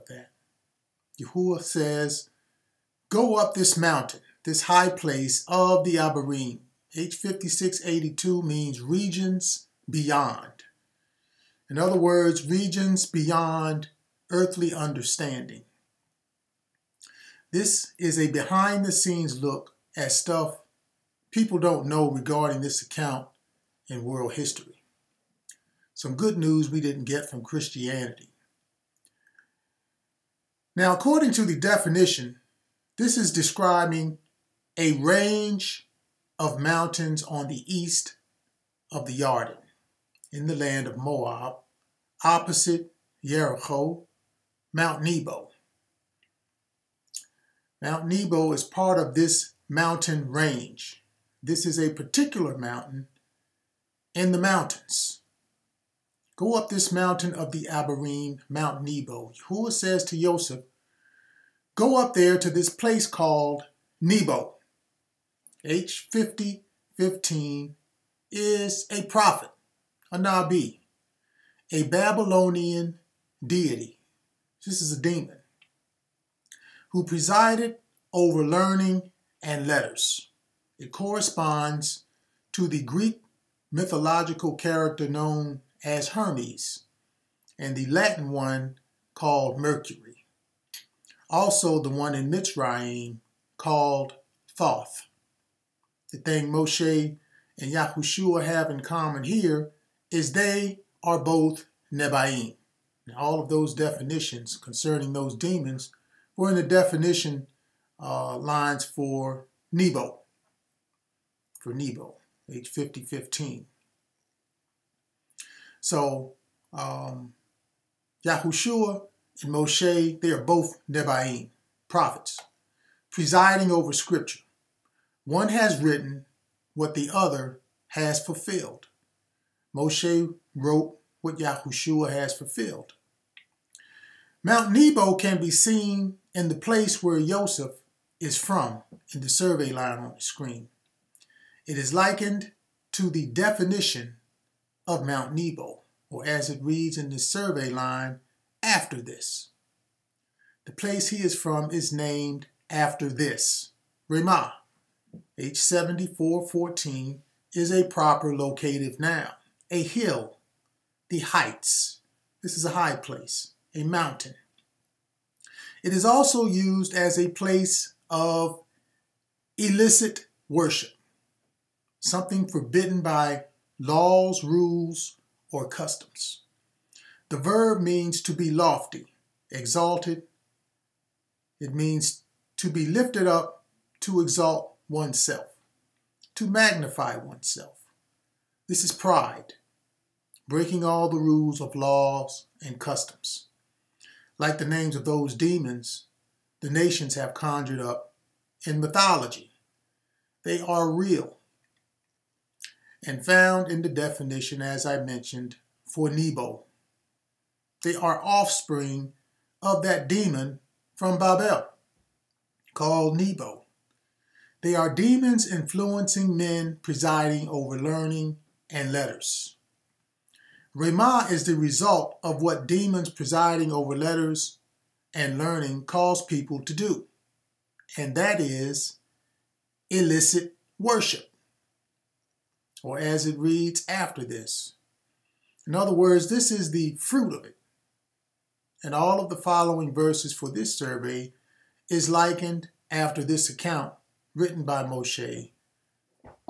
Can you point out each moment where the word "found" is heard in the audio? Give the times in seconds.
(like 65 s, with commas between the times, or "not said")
203 s.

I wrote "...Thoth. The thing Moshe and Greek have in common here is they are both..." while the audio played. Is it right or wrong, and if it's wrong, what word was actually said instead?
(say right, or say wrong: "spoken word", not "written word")
wrong: "Yahushua", not "Greek".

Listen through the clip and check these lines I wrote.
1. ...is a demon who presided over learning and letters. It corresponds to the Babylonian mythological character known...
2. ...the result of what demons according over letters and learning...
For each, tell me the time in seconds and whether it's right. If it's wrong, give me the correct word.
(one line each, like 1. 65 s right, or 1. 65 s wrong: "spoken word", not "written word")
1. 74 s wrong: "Greek", not "Babylonian"
2. 221 s wrong: "presiding", not "according".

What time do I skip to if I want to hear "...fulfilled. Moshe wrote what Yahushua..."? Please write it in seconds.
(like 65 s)
128 s.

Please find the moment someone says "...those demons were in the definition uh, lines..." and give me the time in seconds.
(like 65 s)
105 s.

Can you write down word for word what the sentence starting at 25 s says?
Some good news we didn't get from Christianity.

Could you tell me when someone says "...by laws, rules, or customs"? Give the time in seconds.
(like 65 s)
173 s.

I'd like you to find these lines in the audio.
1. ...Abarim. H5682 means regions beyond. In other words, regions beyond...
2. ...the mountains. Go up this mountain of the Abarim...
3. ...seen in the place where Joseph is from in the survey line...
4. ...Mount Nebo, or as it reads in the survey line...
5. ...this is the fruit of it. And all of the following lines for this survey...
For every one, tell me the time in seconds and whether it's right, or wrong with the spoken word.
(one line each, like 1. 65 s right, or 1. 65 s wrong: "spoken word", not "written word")
1. 5 s right
2. 54 s right
3. 135 s right
4. 145 s right
5. 236 s wrong: "verses", not "lines".